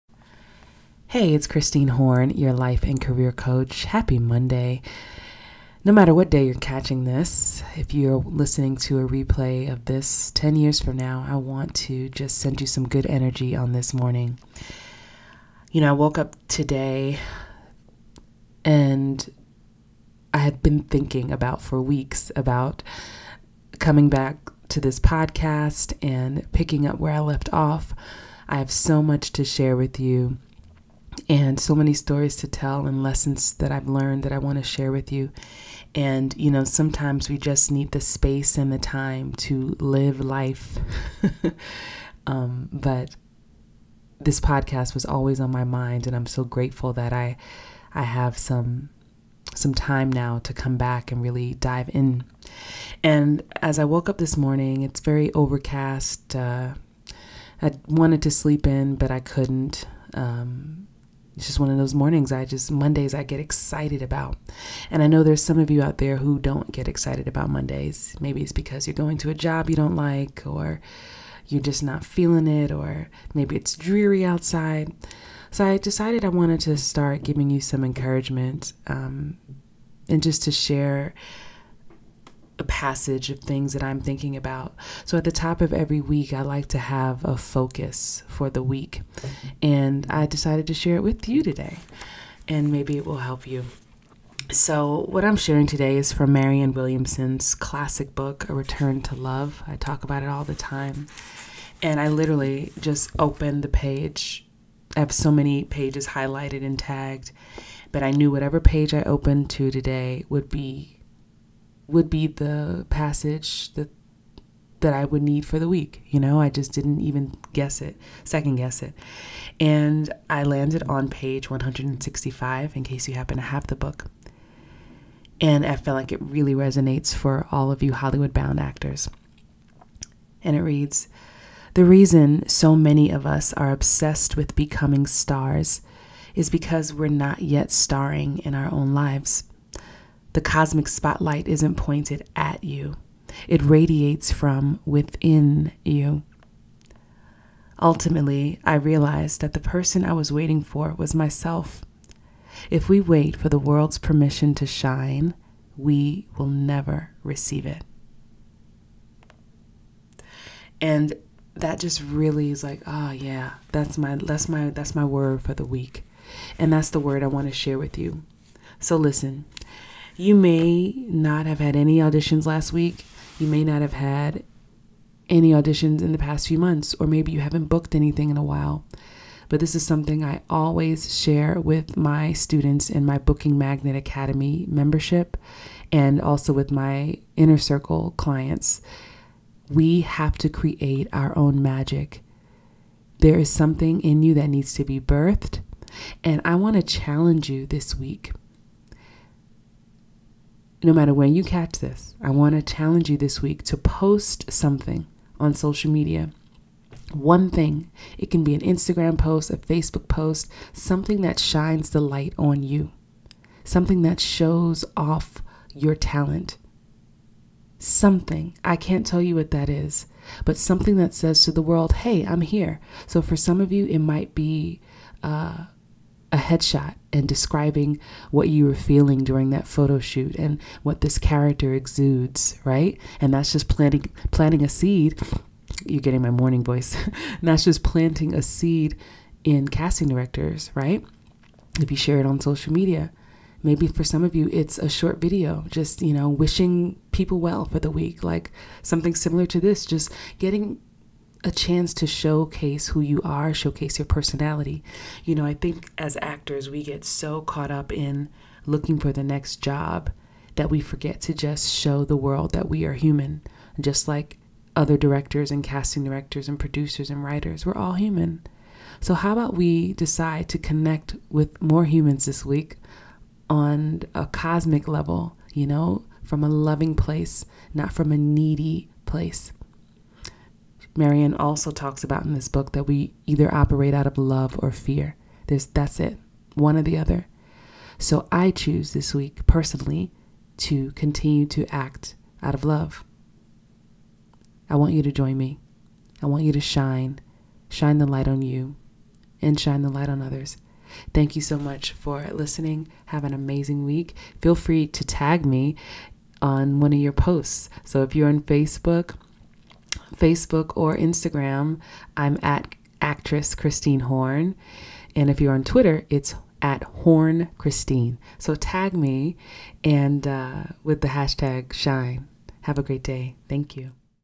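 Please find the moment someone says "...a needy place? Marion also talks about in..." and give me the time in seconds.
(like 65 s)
278 s.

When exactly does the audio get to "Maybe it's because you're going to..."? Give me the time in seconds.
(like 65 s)
68 s.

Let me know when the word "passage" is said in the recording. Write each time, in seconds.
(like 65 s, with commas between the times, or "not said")
82 s, 112 s.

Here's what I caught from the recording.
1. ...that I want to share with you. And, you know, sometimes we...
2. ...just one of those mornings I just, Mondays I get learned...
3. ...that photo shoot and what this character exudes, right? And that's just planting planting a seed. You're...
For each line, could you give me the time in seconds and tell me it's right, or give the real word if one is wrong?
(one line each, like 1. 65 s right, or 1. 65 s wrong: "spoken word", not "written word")
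1. 34 s right
2. 61 s wrong: "excited", not "learned"
3. 229 s right.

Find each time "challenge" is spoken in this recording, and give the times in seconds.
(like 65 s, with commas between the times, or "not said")
196 s, 202 s.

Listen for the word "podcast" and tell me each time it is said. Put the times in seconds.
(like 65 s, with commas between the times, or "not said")
24 s, 44 s.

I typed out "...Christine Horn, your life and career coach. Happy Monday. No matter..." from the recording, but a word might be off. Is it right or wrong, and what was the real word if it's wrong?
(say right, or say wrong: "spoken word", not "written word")
right.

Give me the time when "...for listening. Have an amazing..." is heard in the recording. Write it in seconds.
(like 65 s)
301 s.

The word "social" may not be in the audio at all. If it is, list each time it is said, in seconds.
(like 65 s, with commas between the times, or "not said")
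205 s, 242 s.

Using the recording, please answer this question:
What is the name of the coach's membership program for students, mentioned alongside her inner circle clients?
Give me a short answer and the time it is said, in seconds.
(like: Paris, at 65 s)
Booking Magnet Academy, at 183 s.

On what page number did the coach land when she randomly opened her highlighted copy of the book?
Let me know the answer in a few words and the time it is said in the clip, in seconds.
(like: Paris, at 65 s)
165, at 121 s.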